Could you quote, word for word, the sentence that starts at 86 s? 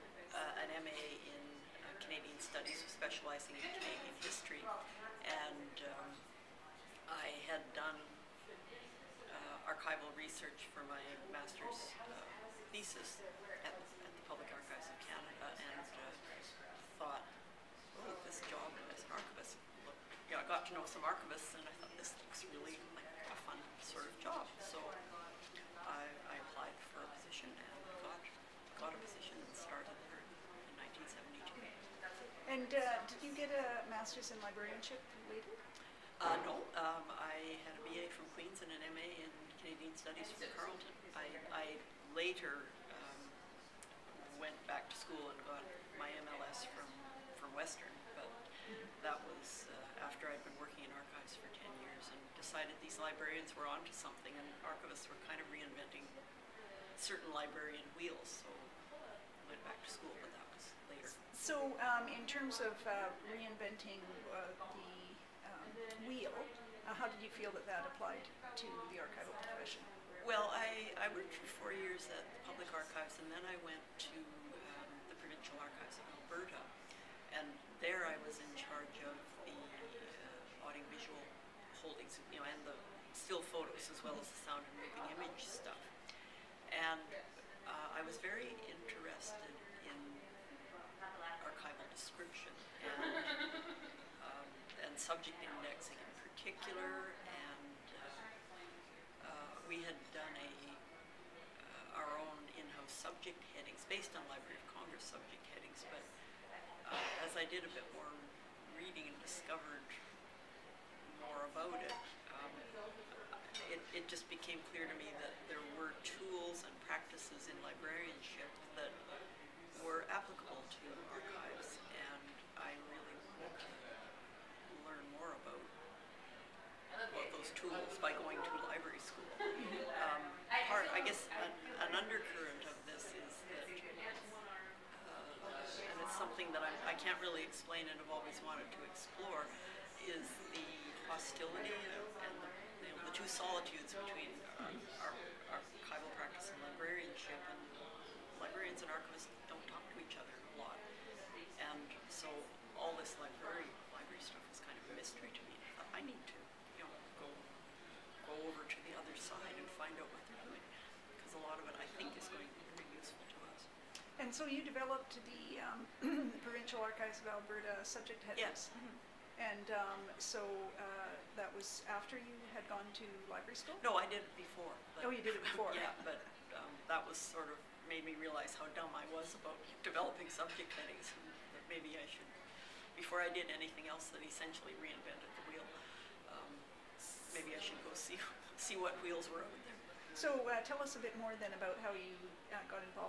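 And uh, I was very interested in archival description.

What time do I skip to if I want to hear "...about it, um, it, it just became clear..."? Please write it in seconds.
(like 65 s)
111 s.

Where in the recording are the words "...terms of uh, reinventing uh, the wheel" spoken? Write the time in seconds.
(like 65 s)
62 s.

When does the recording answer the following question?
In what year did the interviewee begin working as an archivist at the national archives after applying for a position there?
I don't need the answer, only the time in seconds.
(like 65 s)
30 s.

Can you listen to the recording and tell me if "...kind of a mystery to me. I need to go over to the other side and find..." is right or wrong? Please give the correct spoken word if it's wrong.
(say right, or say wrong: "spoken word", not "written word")
right.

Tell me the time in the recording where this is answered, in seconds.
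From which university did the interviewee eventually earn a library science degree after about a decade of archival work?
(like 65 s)
47 s.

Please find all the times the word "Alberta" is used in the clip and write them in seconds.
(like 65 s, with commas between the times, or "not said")
76 s, 167 s.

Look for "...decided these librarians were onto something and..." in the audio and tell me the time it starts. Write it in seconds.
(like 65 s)
52 s.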